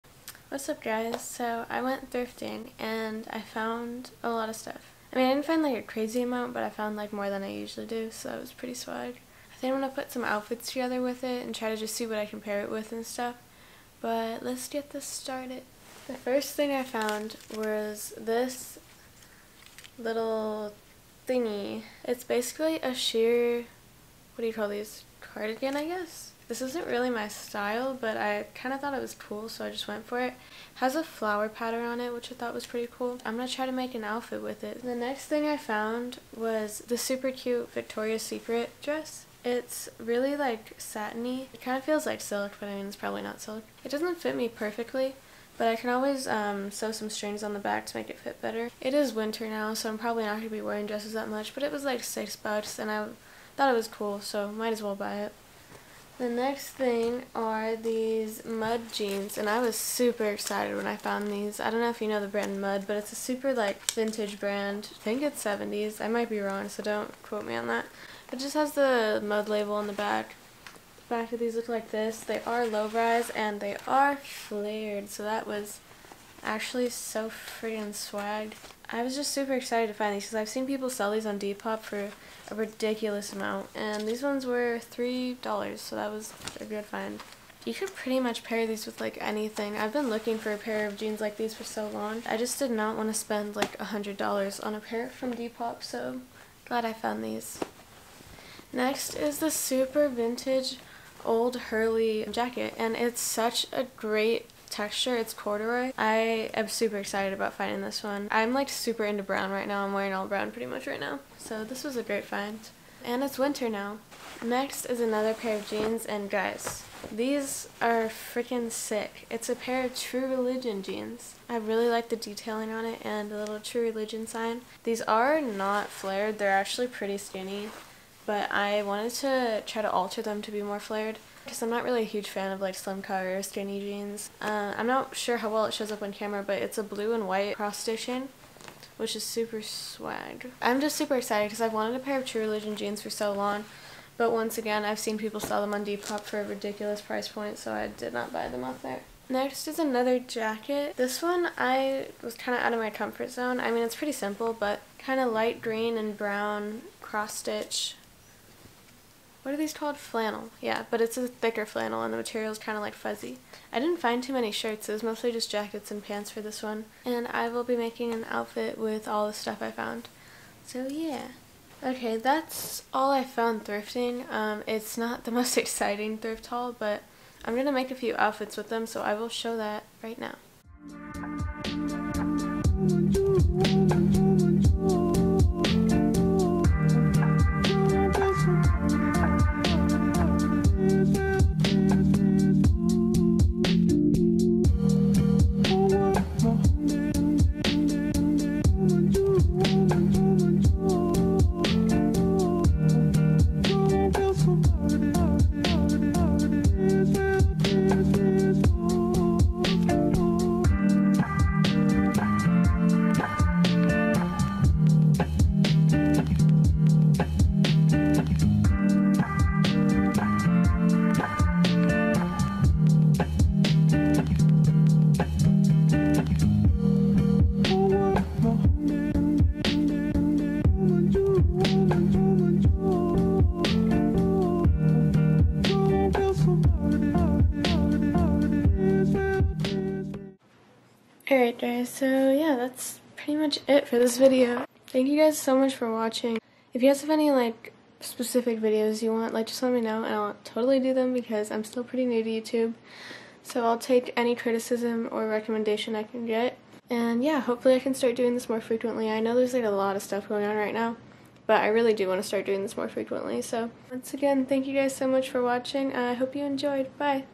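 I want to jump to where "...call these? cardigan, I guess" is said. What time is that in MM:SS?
00:24.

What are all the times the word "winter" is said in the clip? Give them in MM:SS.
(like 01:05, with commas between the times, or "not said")
00:49, 01:53.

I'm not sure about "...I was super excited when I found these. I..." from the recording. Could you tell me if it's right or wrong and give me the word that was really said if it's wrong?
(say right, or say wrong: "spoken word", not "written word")
right.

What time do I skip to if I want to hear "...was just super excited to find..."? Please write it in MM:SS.
01:19.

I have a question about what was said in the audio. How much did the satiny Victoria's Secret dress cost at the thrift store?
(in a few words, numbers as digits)
$6.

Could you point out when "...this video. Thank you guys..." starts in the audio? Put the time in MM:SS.
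04:03.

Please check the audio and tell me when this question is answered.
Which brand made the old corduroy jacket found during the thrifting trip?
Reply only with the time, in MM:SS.
01:41.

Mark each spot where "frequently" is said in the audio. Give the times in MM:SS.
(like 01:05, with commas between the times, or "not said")
04:18, 04:22.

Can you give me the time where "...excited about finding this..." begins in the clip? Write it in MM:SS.
01:46.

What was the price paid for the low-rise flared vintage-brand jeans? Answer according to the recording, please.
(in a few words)
$3.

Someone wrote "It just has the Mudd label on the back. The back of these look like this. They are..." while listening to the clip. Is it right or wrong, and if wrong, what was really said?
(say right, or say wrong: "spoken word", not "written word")
right.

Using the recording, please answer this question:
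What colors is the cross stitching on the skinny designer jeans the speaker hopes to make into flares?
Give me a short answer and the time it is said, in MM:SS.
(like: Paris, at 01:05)
Blue and white, at 02:16.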